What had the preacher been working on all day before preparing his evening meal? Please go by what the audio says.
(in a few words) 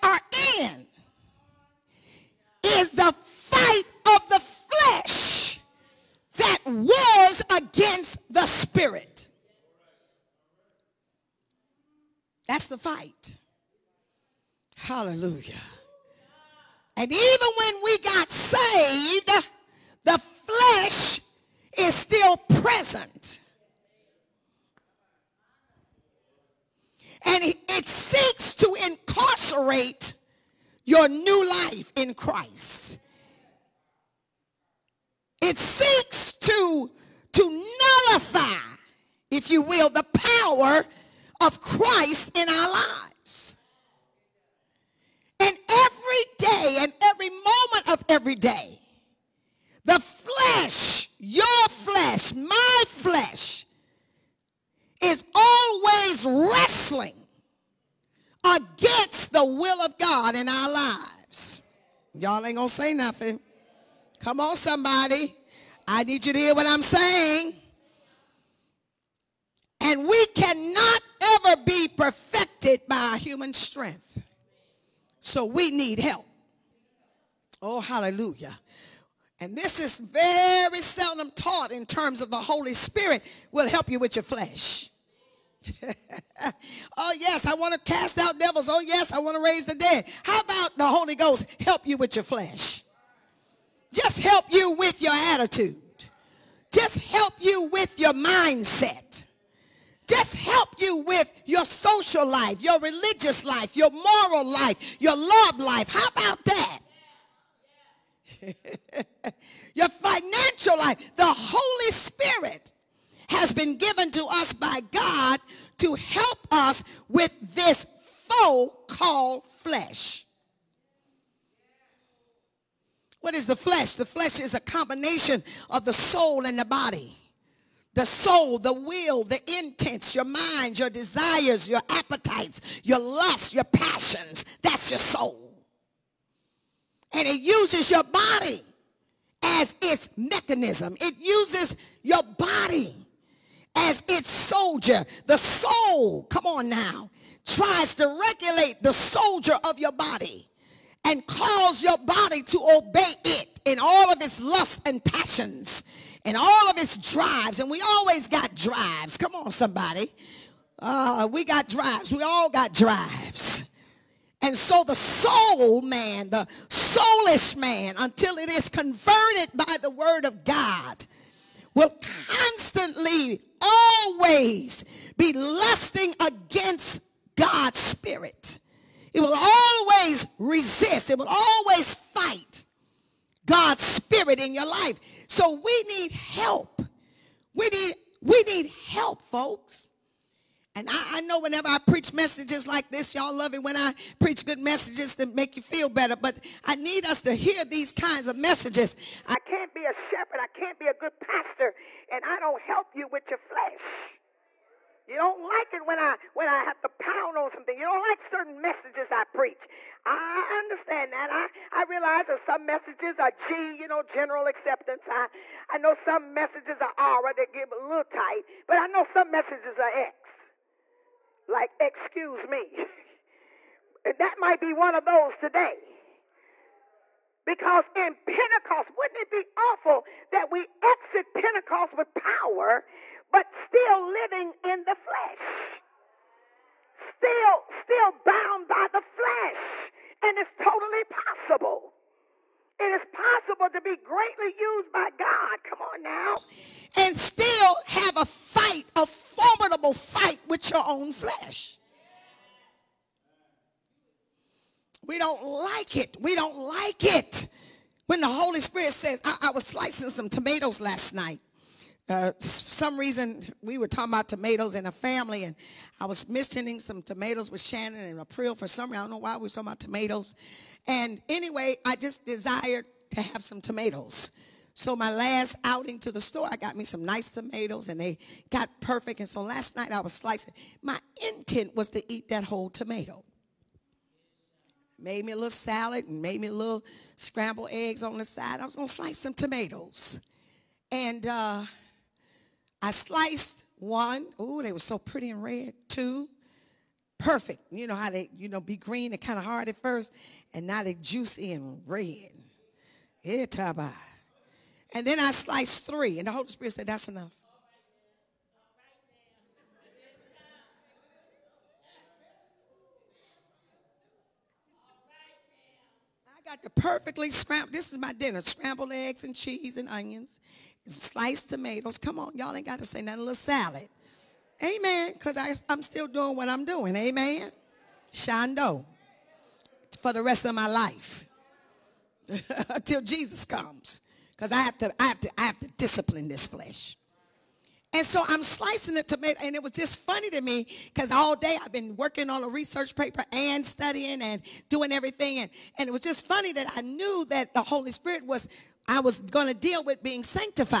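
a research paper.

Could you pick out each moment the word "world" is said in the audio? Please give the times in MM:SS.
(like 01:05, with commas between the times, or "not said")
not said.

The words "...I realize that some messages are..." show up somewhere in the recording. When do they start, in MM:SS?
03:31.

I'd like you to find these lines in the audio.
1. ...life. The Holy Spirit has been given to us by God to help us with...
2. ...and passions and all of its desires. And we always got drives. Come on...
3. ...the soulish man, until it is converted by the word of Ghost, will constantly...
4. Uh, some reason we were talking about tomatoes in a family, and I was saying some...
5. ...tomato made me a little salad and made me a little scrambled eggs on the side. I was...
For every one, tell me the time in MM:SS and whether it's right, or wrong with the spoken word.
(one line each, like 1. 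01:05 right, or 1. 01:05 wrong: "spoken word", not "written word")
1. 01:50 right
2. 02:34 wrong: "drives", not "desires"
3. 02:46 wrong: "God", not "Ghost"
4. 04:22 wrong: "mentioning", not "saying"
5. 04:42 right.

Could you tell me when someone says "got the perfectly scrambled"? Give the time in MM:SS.
05:16.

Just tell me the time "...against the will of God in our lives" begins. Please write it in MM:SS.
00:58.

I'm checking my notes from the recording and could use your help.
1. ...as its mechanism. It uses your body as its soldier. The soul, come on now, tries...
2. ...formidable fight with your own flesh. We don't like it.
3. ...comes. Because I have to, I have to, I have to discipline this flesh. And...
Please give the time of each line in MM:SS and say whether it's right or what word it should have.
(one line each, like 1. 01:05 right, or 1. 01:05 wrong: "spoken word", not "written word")
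1. 02:19 right
2. 04:09 right
3. 05:33 right.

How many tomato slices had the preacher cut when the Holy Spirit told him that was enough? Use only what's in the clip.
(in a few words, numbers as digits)
3.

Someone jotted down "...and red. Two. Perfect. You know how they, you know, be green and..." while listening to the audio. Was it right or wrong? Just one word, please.
right.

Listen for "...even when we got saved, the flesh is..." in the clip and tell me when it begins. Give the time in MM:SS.
00:17.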